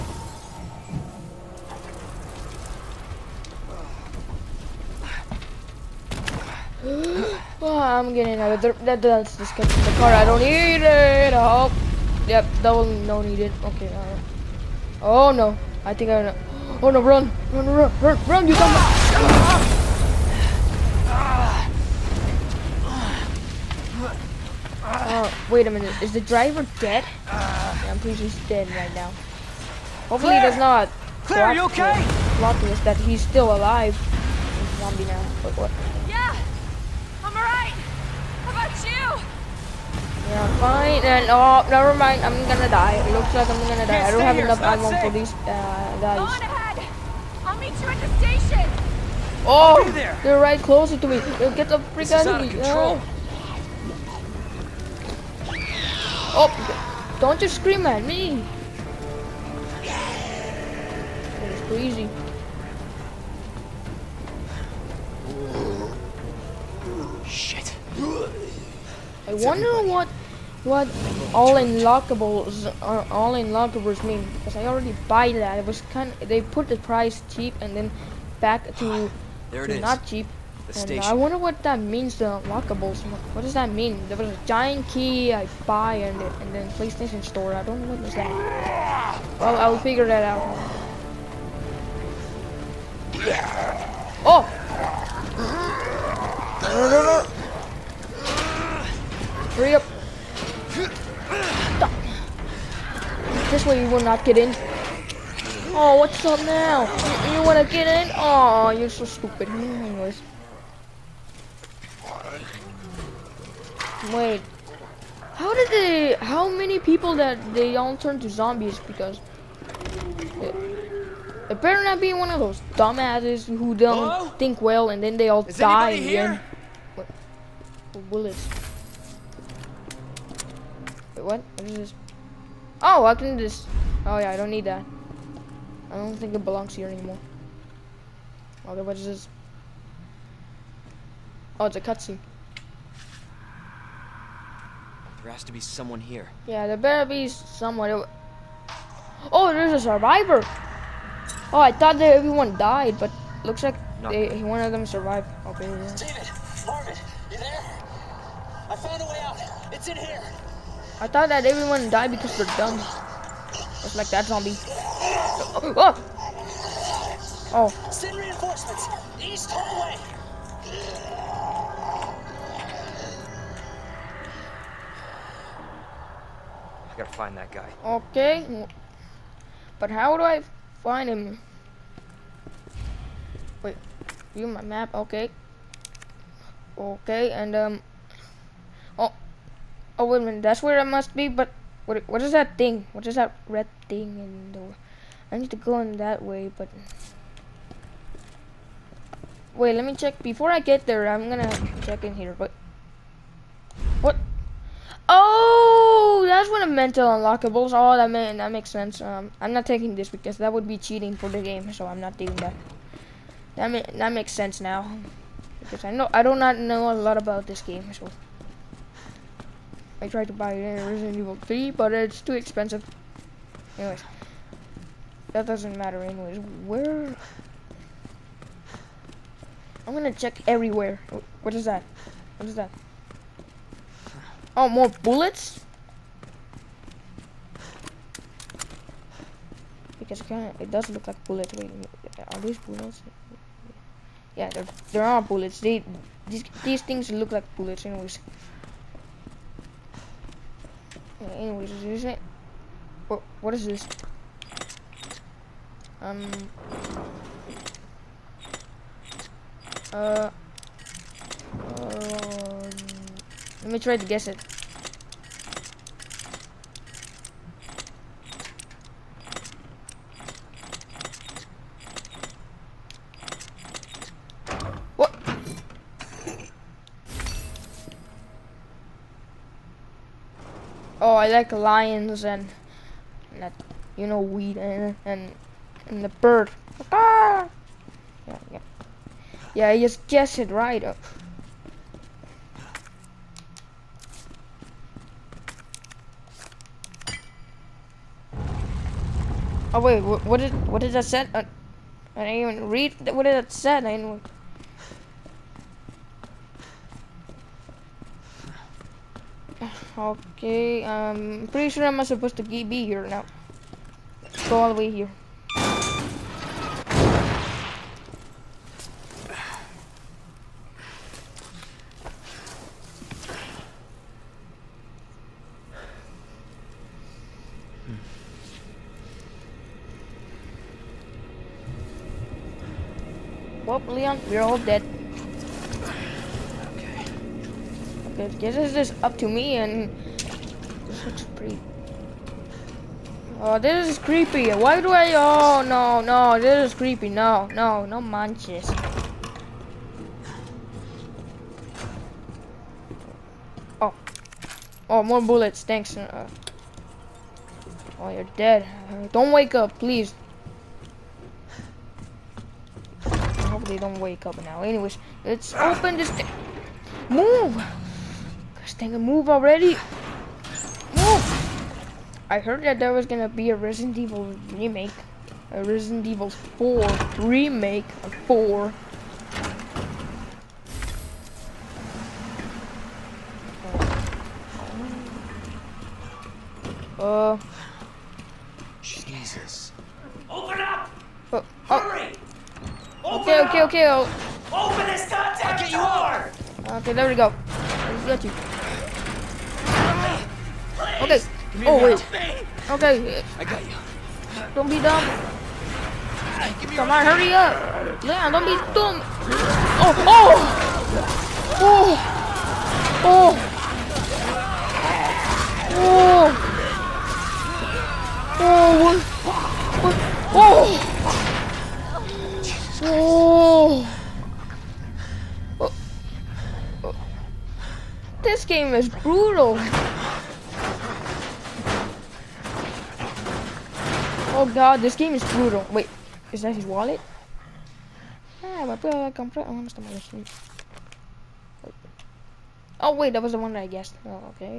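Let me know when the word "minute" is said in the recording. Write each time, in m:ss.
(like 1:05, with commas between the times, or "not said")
0:25, 3:10.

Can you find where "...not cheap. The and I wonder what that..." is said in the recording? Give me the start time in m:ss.
1:19.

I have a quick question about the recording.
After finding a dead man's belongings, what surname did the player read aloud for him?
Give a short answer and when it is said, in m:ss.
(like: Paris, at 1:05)
Morrison, at 7:19.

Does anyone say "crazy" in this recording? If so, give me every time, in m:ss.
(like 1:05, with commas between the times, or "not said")
1:01.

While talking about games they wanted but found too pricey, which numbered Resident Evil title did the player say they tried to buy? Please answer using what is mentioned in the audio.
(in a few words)
Resident Evil 3.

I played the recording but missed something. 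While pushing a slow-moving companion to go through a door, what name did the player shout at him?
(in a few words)
Stinger.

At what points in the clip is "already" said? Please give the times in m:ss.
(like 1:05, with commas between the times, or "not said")
1:14, 6:09.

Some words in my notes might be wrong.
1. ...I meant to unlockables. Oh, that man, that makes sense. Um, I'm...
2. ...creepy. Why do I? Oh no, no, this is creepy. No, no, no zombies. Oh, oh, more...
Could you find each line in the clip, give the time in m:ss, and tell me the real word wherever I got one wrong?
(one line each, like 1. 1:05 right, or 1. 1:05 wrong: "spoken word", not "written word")
1. 3:26 right
2. 5:43 wrong: "manches", not "zombies".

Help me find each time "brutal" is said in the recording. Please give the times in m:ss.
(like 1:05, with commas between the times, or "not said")
7:08, 7:15.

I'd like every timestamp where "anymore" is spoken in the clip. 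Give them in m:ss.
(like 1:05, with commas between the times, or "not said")
2:16.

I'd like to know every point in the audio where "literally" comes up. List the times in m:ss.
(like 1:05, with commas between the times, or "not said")
not said.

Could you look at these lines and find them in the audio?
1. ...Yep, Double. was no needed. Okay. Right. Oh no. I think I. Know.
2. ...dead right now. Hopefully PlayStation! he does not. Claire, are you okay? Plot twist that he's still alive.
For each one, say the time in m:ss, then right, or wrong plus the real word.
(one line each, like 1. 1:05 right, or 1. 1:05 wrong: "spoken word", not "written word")
1. 0:12 right
2. 0:28 wrong: "Claire", not "PlayStation".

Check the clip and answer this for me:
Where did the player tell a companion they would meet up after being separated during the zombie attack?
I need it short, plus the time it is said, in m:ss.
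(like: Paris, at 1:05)
the station, at 0:47.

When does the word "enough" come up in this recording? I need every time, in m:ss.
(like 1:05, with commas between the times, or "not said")
0:44.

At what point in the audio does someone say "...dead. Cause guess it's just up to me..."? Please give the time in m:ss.
5:34.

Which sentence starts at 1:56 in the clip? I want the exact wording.
How many people that they all turn to zombies because...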